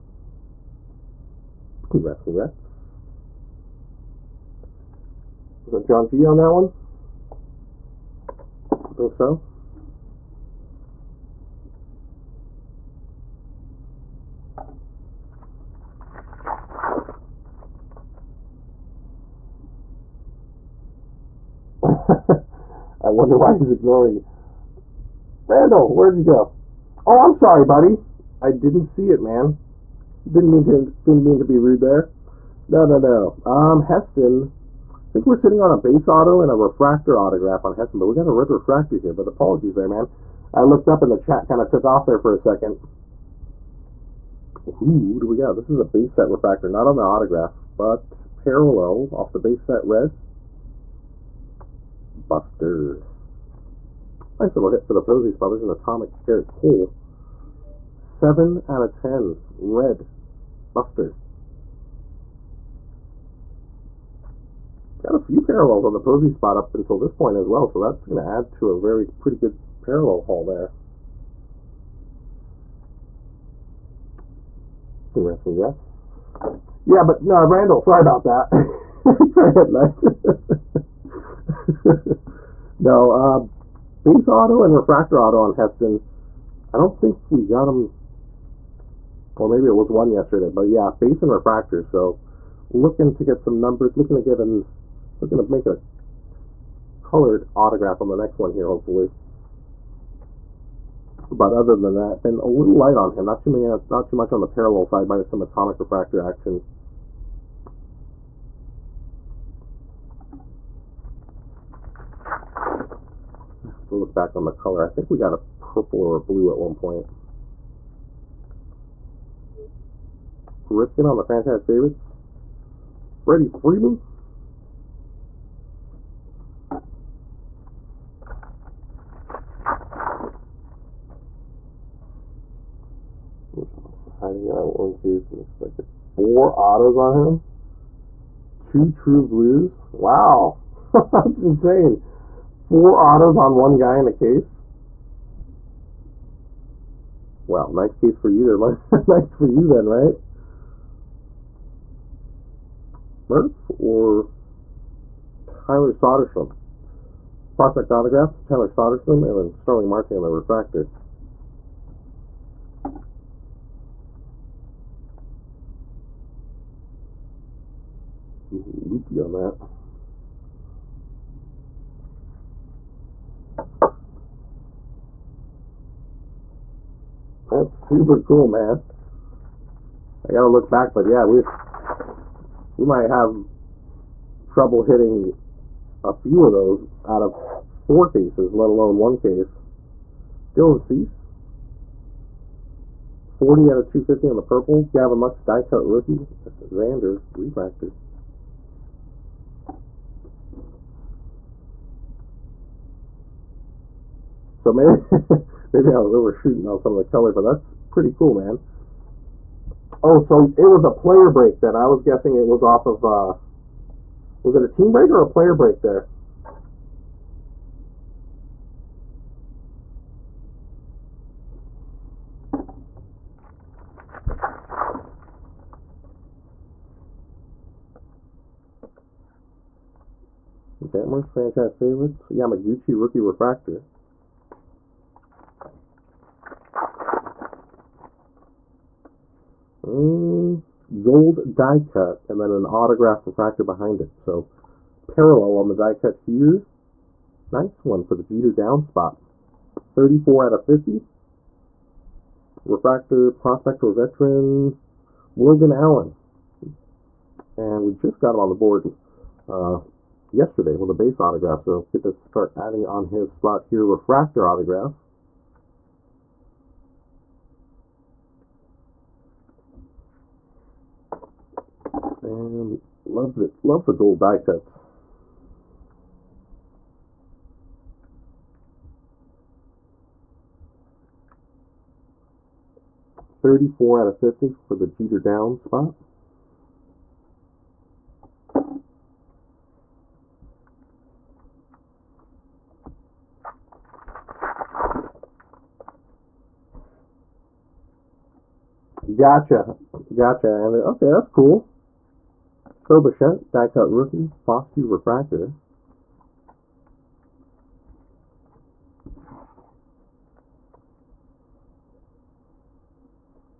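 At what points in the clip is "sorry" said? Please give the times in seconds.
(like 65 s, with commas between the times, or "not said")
27 s, 77 s.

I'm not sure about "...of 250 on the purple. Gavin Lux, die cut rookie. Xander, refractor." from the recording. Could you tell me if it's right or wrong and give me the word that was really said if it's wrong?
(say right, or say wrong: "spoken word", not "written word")
right.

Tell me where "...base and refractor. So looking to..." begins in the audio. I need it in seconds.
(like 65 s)
90 s.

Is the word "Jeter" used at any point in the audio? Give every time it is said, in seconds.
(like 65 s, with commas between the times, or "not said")
248 s, 284 s.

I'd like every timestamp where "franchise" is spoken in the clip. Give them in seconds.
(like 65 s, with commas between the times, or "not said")
121 s, 231 s.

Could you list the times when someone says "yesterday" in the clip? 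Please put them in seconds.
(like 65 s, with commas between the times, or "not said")
90 s, 260 s.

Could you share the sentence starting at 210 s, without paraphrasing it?
Oh, so it was a player break then.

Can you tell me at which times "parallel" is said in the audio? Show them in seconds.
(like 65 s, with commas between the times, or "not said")
48 s, 65 s, 69 s, 104 s, 245 s.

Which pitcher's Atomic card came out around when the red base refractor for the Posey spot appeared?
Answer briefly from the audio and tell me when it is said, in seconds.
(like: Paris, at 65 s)
Gerrit Cole, at 56 s.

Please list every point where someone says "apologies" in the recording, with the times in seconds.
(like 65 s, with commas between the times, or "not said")
39 s.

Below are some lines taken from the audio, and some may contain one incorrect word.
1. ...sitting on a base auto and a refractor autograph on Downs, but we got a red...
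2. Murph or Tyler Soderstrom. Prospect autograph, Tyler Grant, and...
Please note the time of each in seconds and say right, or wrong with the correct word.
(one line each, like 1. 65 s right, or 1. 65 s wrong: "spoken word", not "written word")
1. 35 s wrong: "Heston", not "Downs"
2. 153 s wrong: "Soderstrom", not "Grant".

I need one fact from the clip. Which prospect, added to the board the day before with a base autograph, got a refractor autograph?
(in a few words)
Logan Allen.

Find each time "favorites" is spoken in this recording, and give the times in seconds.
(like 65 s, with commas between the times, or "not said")
121 s, 231 s.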